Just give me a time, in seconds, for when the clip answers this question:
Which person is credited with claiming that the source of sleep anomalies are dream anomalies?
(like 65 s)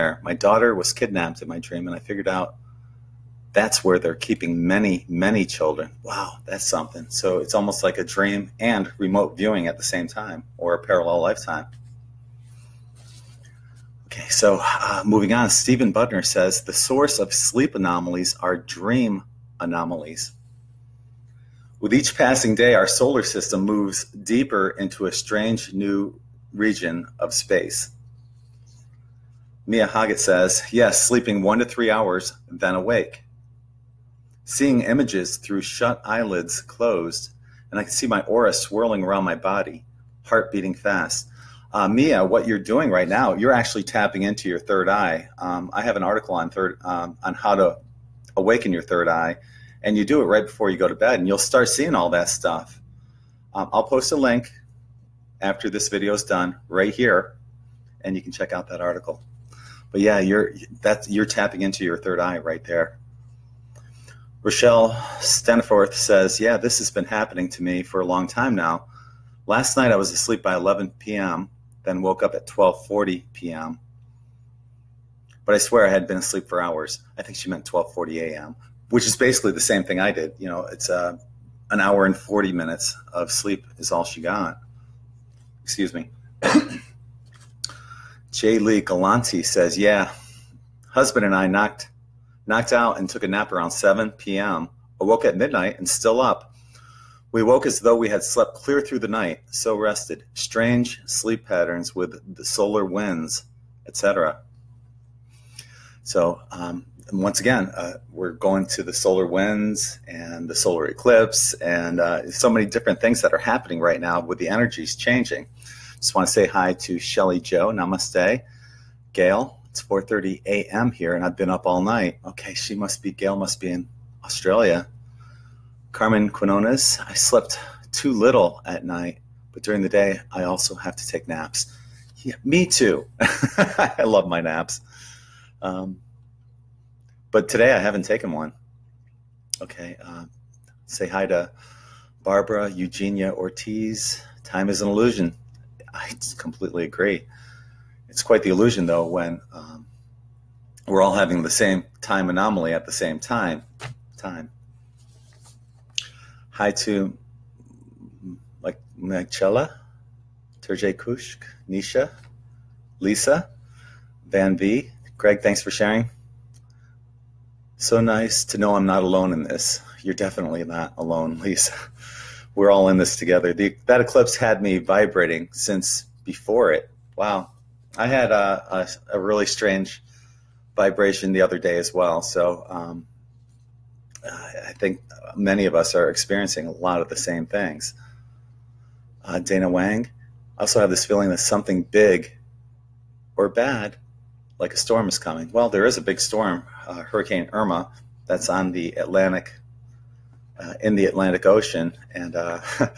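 15 s.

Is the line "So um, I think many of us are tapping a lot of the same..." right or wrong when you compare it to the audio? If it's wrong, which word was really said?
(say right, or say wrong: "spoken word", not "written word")
wrong: "experiencing", not "tapping".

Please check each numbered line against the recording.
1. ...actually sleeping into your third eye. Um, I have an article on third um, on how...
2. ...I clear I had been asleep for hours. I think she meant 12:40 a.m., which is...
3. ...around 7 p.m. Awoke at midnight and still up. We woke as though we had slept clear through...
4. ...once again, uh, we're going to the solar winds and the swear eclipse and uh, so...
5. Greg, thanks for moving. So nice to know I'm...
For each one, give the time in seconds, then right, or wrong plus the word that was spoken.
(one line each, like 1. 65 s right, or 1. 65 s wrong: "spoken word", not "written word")
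1. 43 s wrong: "tapping", not "sleeping"
2. 75 s wrong: "swear", not "clear"
3. 93 s right
4. 107 s wrong: "solar", not "swear"
5. 165 s wrong: "sharing", not "moving".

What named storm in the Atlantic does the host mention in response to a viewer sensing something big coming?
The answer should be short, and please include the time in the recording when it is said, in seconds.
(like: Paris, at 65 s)
Hurricane Irma, at 197 s.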